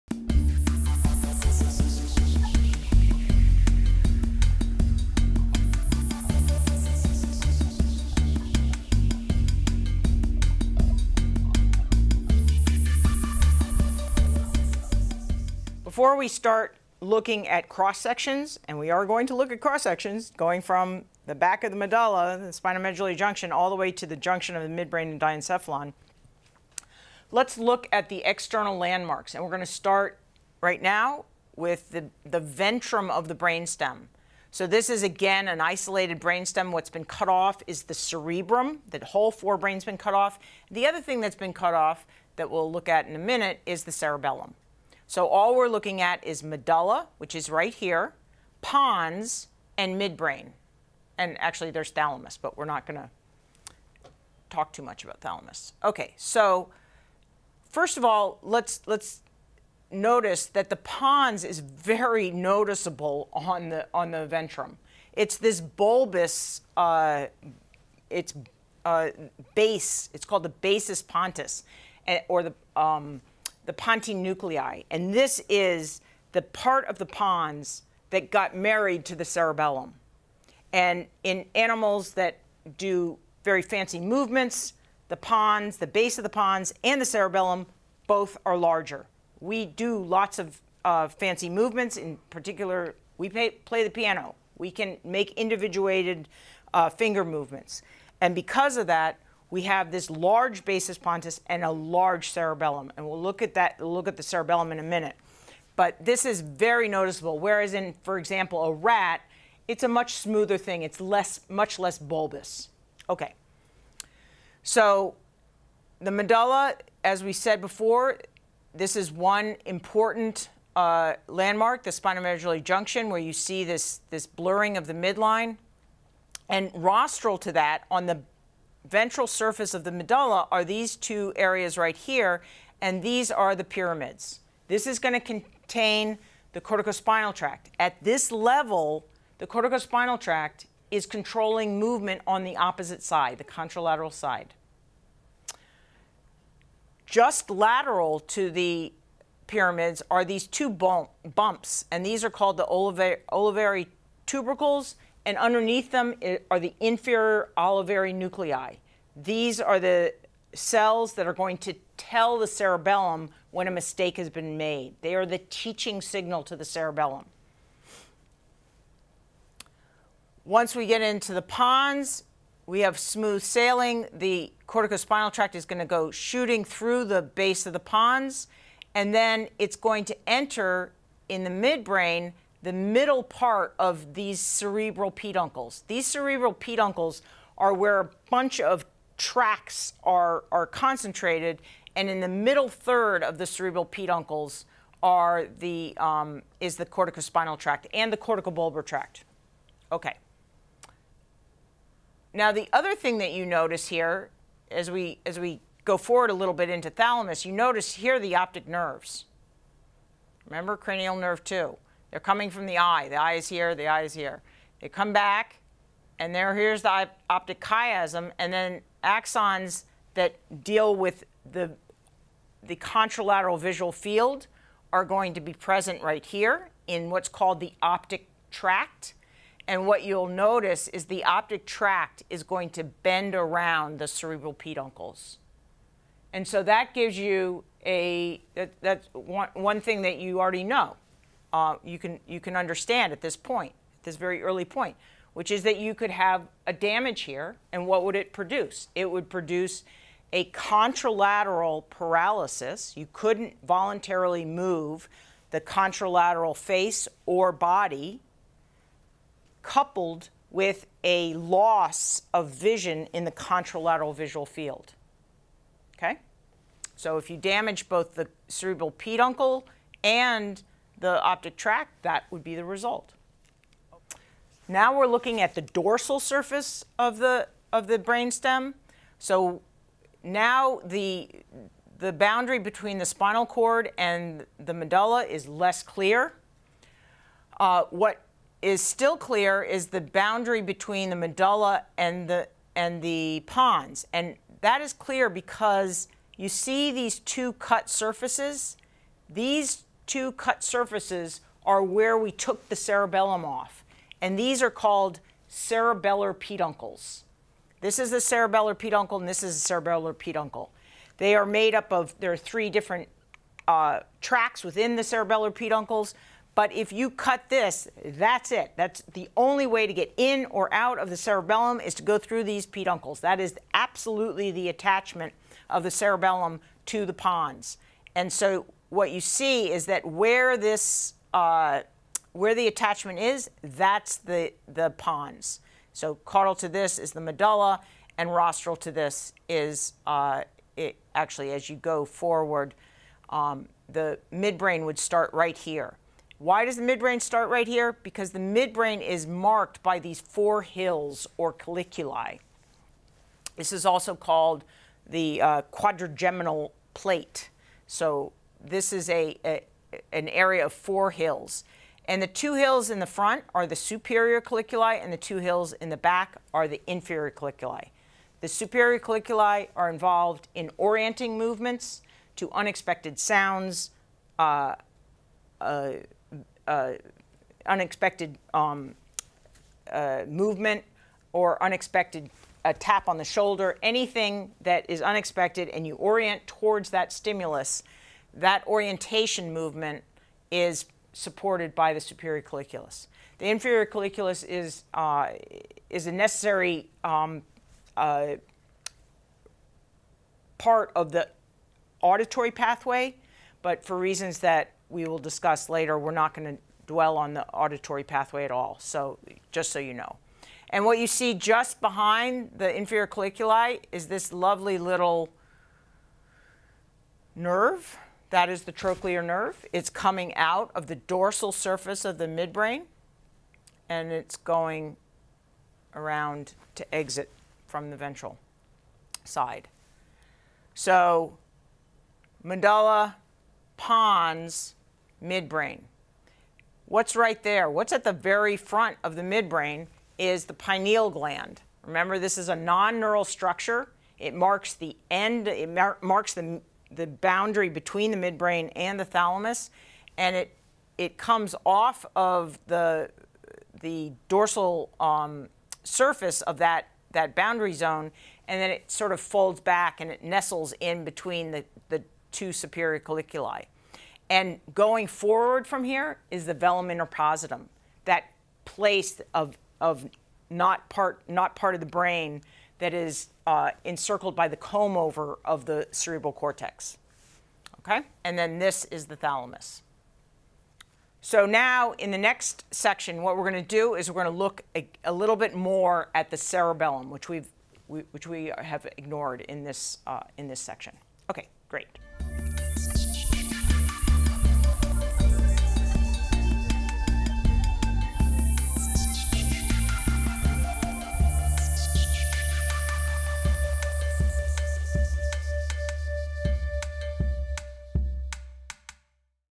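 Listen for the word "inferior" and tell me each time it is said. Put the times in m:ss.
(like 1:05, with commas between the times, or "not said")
2:36, 6:06, 6:33, 6:52.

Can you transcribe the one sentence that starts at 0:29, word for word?
And we're going to start right now with the, the ventrum of the brainstem.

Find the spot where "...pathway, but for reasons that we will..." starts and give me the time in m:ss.
6:42.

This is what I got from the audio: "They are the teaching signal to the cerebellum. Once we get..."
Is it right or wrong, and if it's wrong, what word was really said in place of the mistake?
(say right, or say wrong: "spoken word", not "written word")
right.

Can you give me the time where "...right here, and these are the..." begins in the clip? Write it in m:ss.
2:11.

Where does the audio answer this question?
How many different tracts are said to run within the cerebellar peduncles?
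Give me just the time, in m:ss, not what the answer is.
5:12.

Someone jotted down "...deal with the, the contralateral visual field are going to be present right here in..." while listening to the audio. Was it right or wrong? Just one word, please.
right.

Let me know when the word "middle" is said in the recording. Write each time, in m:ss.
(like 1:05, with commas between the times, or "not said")
3:02, 3:12.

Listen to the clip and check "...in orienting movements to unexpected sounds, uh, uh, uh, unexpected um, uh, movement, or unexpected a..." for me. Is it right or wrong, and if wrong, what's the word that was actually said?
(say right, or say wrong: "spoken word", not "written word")
right.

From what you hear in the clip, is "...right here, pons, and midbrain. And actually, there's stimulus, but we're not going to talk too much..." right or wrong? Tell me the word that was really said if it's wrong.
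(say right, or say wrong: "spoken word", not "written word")
wrong: "thalamus", not "stimulus".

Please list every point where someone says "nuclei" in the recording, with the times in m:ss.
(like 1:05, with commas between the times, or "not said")
1:14, 2:38.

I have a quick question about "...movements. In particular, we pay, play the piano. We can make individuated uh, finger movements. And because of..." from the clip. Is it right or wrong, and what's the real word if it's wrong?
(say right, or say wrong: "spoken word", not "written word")
right.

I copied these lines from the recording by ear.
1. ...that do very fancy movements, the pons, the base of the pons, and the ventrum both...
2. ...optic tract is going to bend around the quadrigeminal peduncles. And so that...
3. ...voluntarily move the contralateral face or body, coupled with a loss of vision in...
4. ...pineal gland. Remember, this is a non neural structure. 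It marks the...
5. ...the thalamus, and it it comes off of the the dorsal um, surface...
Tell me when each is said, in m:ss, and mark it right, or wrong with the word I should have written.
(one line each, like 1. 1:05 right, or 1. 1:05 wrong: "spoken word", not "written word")
1. 1:22 wrong: "cerebellum", not "ventrum"
2. 3:51 wrong: "cerebral", not "quadrigeminal"
3. 4:13 right
4. 7:20 right
5. 7:28 right.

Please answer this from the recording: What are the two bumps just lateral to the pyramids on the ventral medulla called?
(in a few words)
Olivary tubercles.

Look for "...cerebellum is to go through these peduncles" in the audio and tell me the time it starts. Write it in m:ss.
5:21.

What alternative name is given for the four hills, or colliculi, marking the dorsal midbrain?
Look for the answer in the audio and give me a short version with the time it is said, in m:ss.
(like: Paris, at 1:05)
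Quadrigeminal plate, at 5:55.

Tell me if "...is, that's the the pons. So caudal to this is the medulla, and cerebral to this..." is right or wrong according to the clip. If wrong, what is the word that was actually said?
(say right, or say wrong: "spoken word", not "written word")
wrong: "rostral", not "cerebral".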